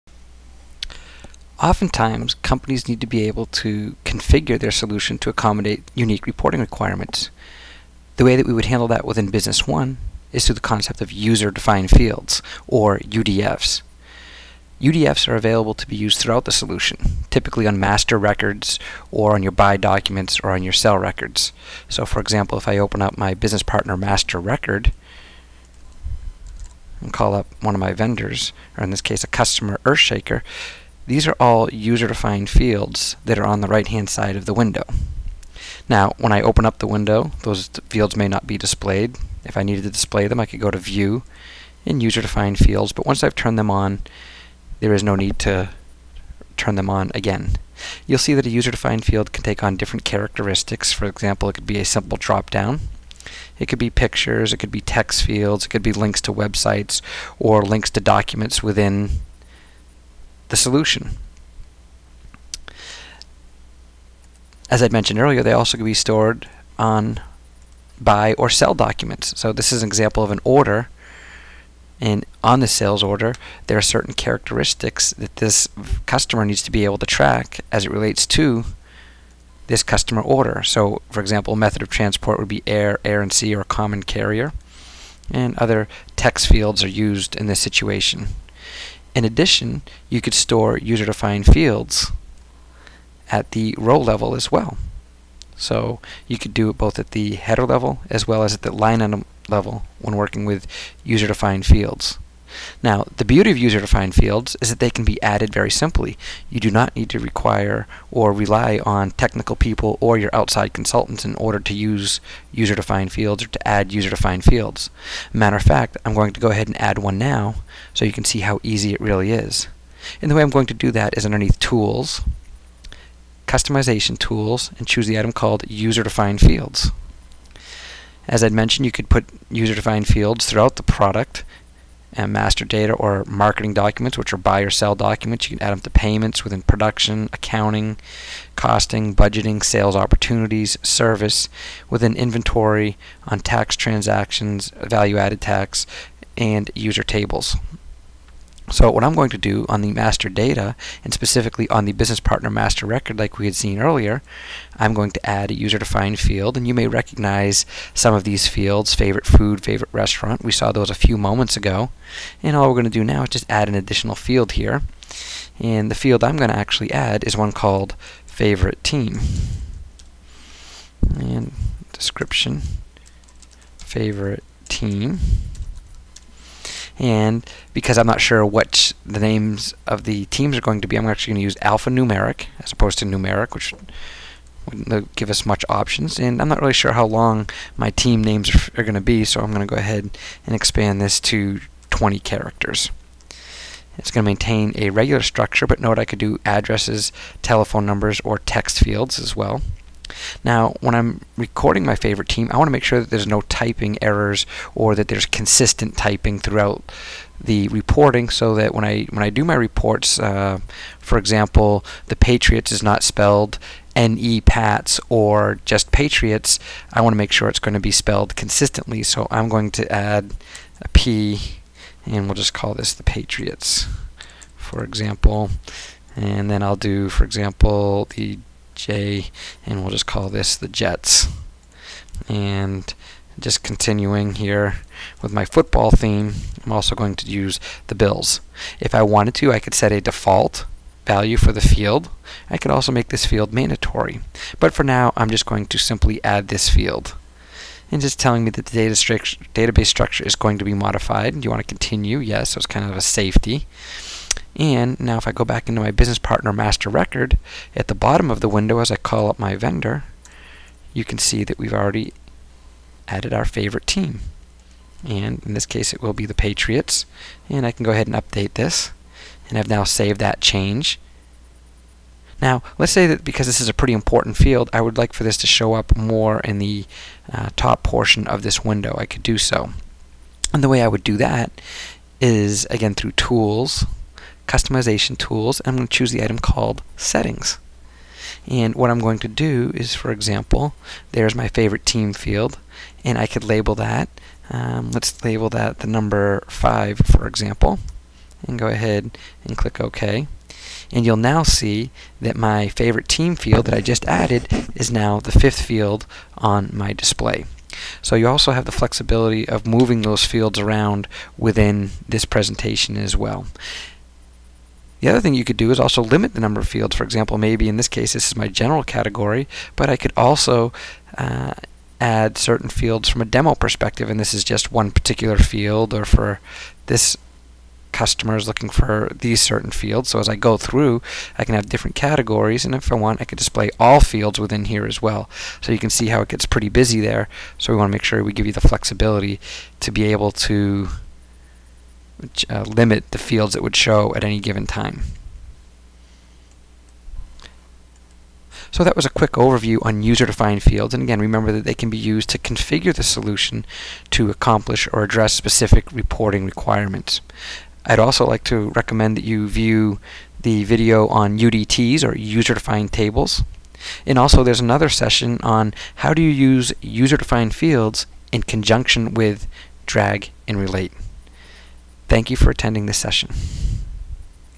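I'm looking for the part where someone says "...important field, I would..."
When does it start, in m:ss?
4:33.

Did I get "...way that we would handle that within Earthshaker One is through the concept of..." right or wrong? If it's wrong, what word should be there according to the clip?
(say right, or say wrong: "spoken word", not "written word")
wrong: "Business", not "Earthshaker".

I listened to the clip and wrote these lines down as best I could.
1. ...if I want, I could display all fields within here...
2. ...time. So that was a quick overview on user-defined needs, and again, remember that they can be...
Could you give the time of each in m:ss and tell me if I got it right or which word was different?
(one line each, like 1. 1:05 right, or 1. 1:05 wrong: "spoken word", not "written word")
1. 5:32 right
2. 5:44 wrong: "fields", not "needs".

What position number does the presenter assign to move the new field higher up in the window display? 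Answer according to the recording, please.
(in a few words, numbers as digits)
5.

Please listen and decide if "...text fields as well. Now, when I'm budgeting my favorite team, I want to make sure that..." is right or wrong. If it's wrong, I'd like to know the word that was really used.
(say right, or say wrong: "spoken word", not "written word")
wrong: "recording", not "budgeting".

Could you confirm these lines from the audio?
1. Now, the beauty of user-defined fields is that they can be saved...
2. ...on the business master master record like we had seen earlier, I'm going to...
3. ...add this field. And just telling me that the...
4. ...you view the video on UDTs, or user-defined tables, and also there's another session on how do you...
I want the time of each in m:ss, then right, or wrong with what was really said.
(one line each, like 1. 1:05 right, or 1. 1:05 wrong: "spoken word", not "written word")
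1. 1:42 wrong: "added", not "saved"
2. 2:31 wrong: "partner", not "master"
3. 4:06 right
4. 5:59 right.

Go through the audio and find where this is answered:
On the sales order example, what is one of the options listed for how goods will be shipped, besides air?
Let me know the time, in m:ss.
1:23.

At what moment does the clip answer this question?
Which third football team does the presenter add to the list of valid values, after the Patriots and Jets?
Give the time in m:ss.
3:57.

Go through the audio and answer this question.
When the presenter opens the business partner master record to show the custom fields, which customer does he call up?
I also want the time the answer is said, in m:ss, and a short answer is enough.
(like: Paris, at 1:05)
Earthshaker, at 0:29.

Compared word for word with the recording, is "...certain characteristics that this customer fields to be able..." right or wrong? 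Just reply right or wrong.
wrong.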